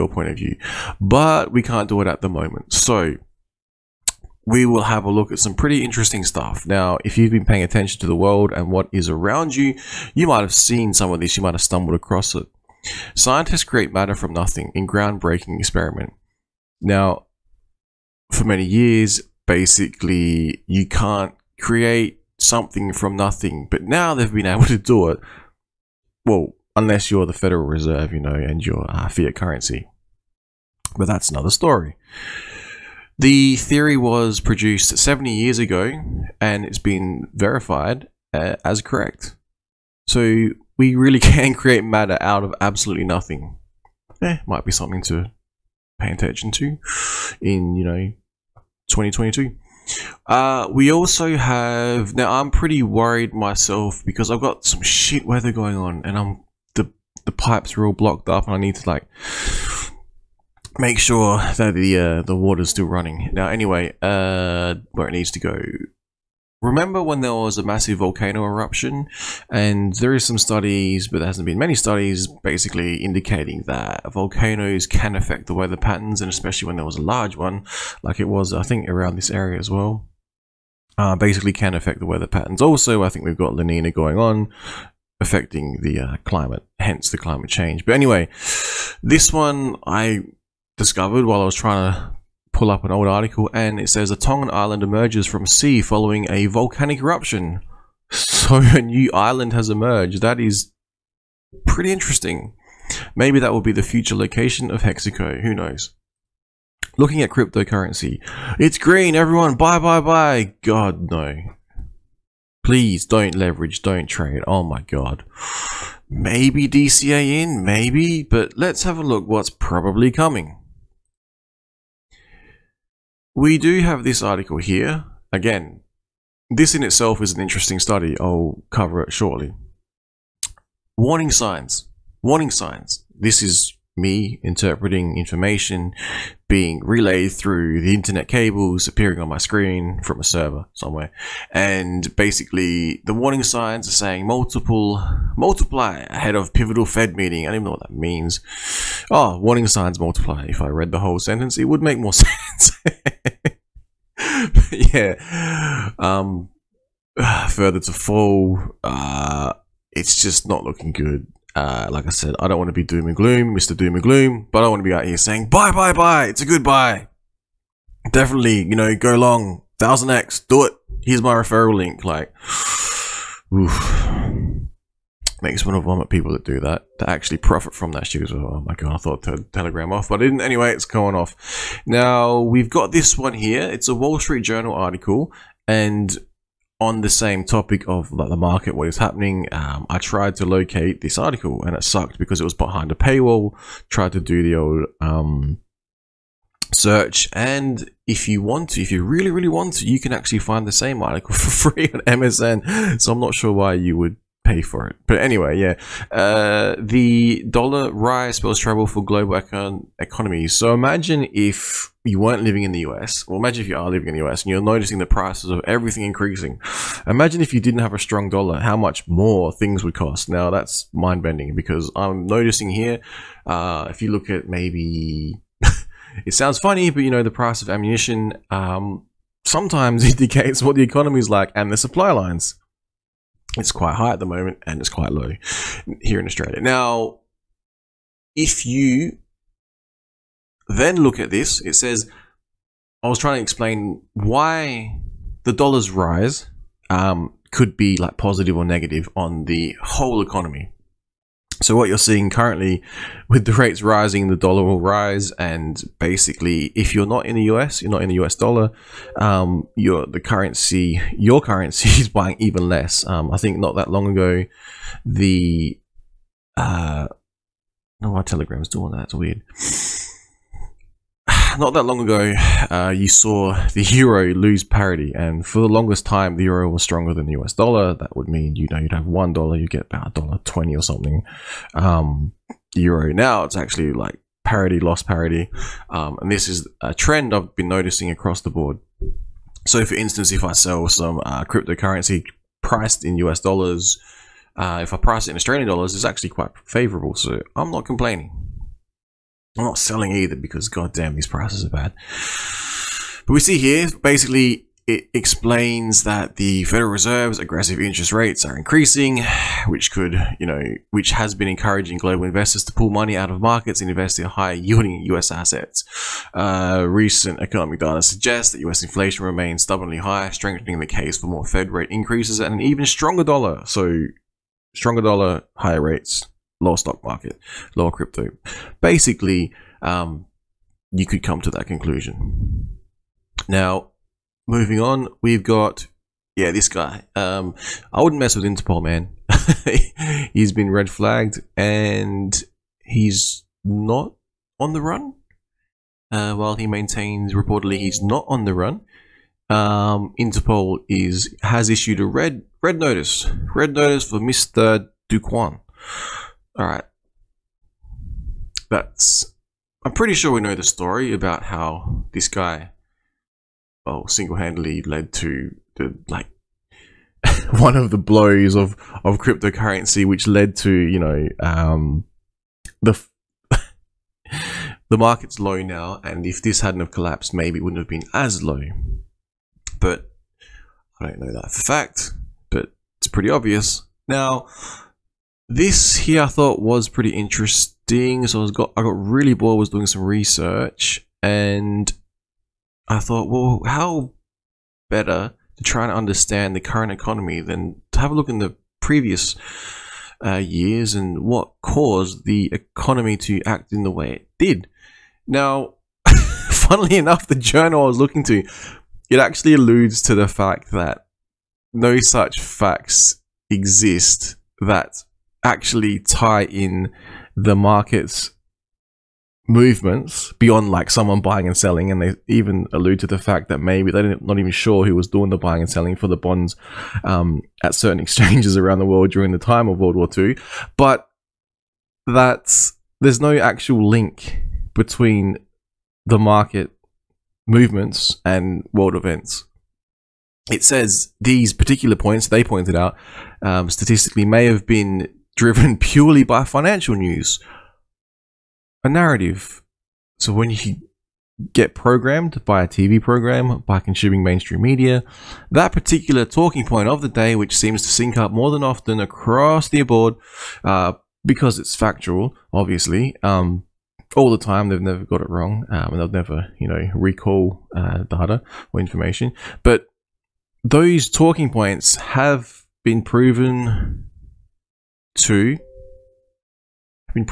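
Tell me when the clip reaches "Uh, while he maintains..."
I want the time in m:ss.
5:46.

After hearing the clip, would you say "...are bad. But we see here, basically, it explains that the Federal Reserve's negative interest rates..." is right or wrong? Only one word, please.
wrong.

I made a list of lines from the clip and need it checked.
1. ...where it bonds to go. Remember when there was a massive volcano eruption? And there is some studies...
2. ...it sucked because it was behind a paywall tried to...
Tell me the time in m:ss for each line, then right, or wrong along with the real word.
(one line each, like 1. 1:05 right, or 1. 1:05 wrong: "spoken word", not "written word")
1. 1:04 wrong: "needs", not "bonds"
2. 3:11 right.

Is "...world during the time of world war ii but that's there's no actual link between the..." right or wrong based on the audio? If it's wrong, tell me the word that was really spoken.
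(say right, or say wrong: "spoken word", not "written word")
right.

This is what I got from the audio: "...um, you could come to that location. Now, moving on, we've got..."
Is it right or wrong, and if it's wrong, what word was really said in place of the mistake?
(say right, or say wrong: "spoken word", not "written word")
wrong: "conclusion", not "location".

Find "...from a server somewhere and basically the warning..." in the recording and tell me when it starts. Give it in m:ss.
2:20.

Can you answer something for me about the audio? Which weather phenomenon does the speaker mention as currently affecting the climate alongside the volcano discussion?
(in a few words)
La Nina.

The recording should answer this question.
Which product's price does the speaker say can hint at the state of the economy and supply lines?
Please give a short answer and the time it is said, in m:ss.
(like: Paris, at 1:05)
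Ammunition, at 3:47.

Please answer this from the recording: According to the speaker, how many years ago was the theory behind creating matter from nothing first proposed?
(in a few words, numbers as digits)
70.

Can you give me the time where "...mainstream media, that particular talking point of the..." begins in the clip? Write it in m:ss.
7:34.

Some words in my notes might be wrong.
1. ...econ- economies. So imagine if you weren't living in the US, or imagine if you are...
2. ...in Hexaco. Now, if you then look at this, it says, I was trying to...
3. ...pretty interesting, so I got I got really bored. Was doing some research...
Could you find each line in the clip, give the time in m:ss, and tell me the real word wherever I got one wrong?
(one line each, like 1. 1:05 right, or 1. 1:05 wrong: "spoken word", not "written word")
1. 3:29 right
2. 3:56 wrong: "Australia", not "Hexaco"
3. 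6:26 right.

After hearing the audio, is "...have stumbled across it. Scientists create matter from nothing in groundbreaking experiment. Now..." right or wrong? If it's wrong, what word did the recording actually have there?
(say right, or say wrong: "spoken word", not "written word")
right.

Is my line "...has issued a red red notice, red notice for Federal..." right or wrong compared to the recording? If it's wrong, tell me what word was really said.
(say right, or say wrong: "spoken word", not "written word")
wrong: "Mister", not "Federal".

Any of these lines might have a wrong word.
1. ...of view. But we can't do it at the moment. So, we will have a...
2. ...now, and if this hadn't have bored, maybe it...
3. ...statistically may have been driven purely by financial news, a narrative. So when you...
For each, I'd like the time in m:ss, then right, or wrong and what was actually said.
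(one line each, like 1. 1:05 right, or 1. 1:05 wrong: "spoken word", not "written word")
1. 0:00 right
2. 6:15 wrong: "collapsed", not "bored"
3. 7:23 right.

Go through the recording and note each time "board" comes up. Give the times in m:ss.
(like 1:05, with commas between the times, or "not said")
4:48, 7:39.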